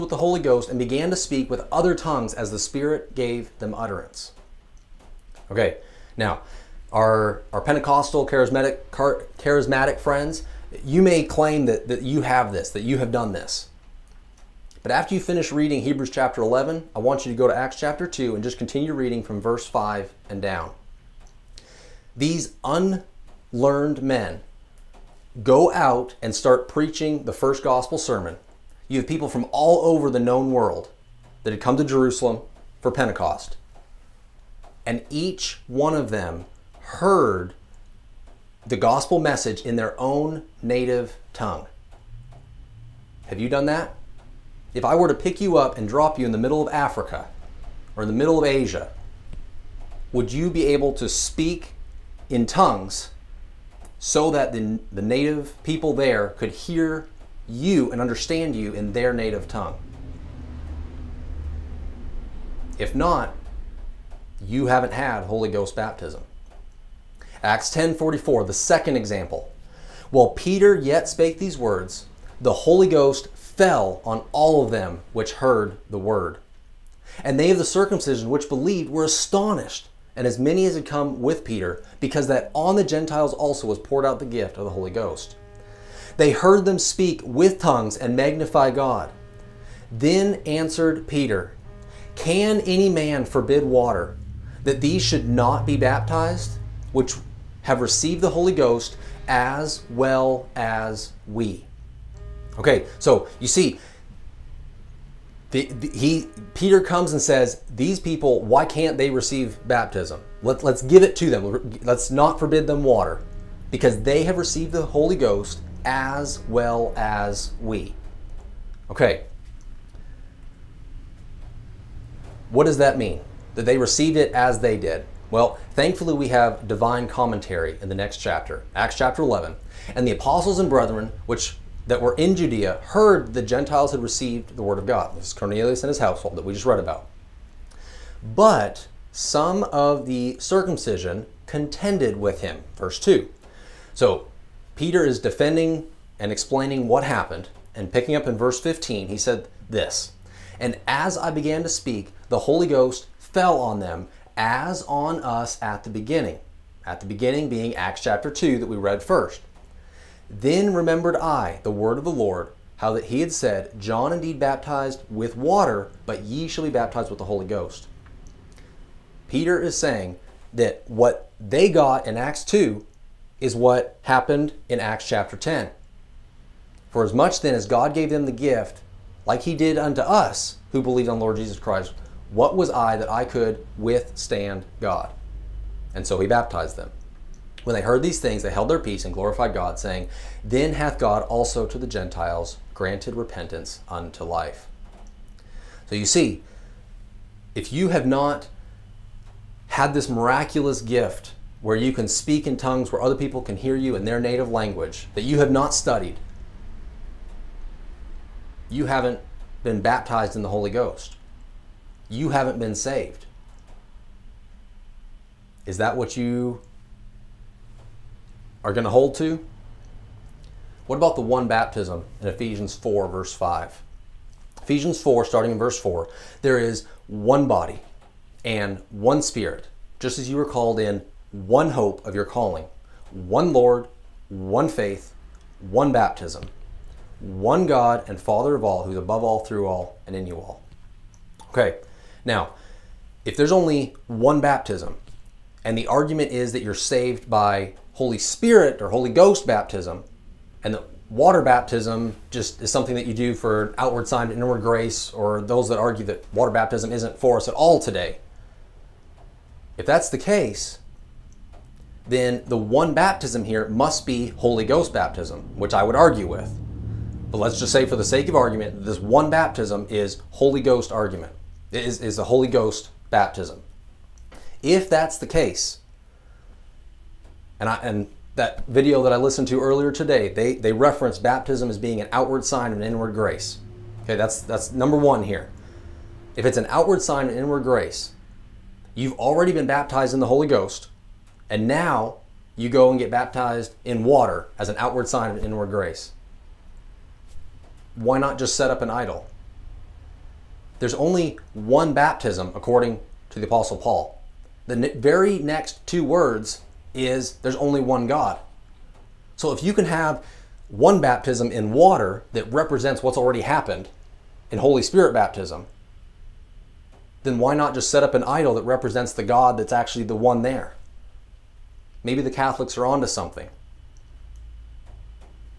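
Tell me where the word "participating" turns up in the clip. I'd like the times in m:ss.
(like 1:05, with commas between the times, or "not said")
not said.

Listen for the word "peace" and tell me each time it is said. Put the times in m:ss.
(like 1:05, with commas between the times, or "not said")
3:08.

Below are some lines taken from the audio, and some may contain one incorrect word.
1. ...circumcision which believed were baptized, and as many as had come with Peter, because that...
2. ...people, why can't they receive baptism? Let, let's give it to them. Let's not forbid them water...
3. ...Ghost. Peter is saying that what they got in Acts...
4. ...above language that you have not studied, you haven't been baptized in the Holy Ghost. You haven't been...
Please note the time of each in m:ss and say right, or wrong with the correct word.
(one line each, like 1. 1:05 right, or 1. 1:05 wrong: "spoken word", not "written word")
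1. 1:17 wrong: "astonished", not "baptized"
2. 1:47 right
3. 2:47 right
4. 3:24 wrong: "native", not "above".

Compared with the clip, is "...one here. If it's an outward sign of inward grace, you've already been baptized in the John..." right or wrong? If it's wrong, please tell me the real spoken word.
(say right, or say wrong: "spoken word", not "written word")
wrong: "Holy", not "John".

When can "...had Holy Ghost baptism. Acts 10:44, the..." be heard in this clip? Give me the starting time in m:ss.
1:04.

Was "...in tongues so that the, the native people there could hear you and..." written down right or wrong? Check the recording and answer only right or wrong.
right.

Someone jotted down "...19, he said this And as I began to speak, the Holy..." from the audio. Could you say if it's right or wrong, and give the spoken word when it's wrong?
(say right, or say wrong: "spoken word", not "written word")
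wrong: "15", not "19".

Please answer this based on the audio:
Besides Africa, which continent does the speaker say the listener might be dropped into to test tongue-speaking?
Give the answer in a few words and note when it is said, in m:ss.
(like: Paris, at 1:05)
Asia, at 0:48.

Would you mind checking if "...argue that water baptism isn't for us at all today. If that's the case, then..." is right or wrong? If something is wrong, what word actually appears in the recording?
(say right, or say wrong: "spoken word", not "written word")
right.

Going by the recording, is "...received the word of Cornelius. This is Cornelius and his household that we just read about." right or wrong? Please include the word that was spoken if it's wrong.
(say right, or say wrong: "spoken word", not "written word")
wrong: "God", not "Cornelius".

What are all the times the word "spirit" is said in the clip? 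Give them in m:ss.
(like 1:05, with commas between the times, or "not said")
0:02, 3:49, 4:08, 5:14.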